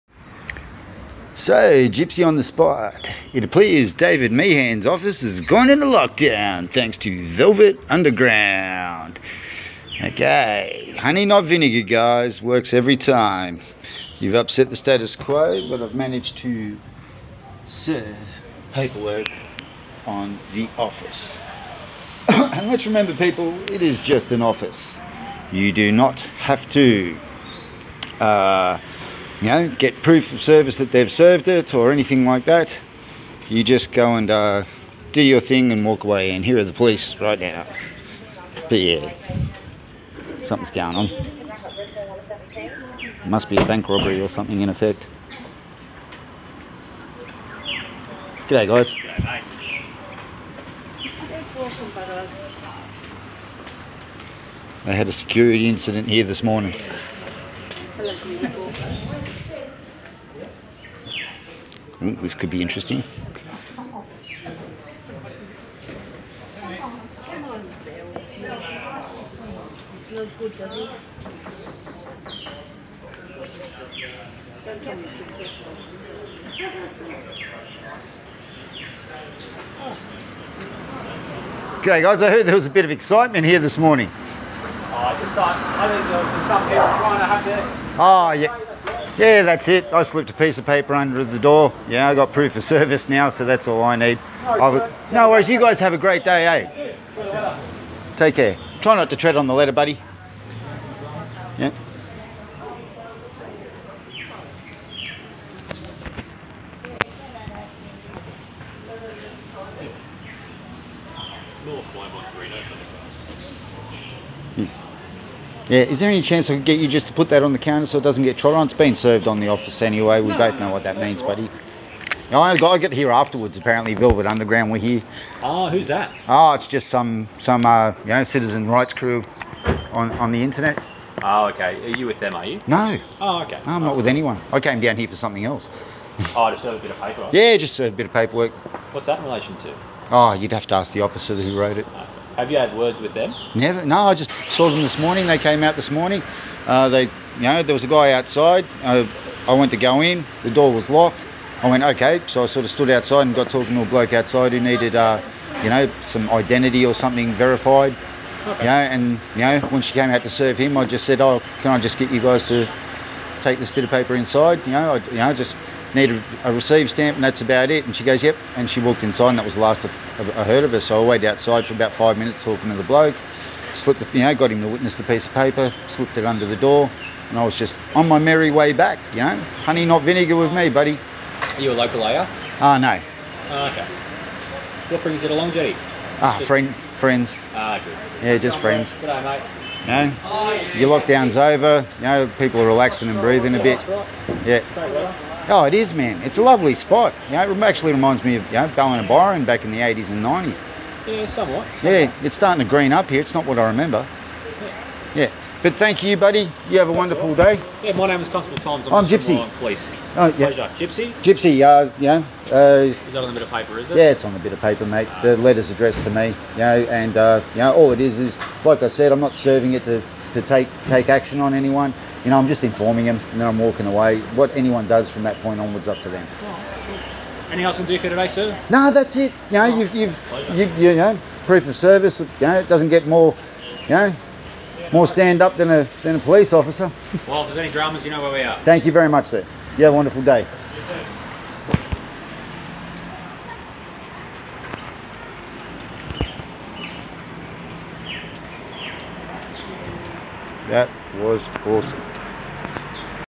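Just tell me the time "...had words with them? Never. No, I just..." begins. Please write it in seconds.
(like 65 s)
142 s.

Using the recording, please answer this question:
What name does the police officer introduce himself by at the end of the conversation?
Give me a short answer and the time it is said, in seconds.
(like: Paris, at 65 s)
Constable Tom, at 208 s.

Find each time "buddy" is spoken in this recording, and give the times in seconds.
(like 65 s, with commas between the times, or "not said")
99 s, 121 s, 180 s, 206 s.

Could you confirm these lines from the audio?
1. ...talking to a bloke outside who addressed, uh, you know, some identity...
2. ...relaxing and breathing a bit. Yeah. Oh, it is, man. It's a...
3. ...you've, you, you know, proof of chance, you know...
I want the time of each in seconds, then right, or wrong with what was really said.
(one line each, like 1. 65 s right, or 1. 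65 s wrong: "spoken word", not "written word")
1. 153 s wrong: "needed", not "addressed"
2. 192 s right
3. 229 s wrong: "service", not "chance".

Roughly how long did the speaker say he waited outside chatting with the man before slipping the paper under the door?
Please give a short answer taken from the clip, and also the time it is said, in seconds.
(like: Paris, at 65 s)
5 minutes, at 171 s.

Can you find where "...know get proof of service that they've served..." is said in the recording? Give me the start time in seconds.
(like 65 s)
29 s.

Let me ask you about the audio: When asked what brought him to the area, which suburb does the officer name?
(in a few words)
Long Jetty.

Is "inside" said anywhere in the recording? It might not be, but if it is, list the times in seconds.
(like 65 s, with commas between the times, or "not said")
164 s, 169 s.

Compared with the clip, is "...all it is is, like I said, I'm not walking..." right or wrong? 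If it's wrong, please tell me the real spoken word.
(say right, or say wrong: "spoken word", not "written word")
wrong: "serving", not "walking".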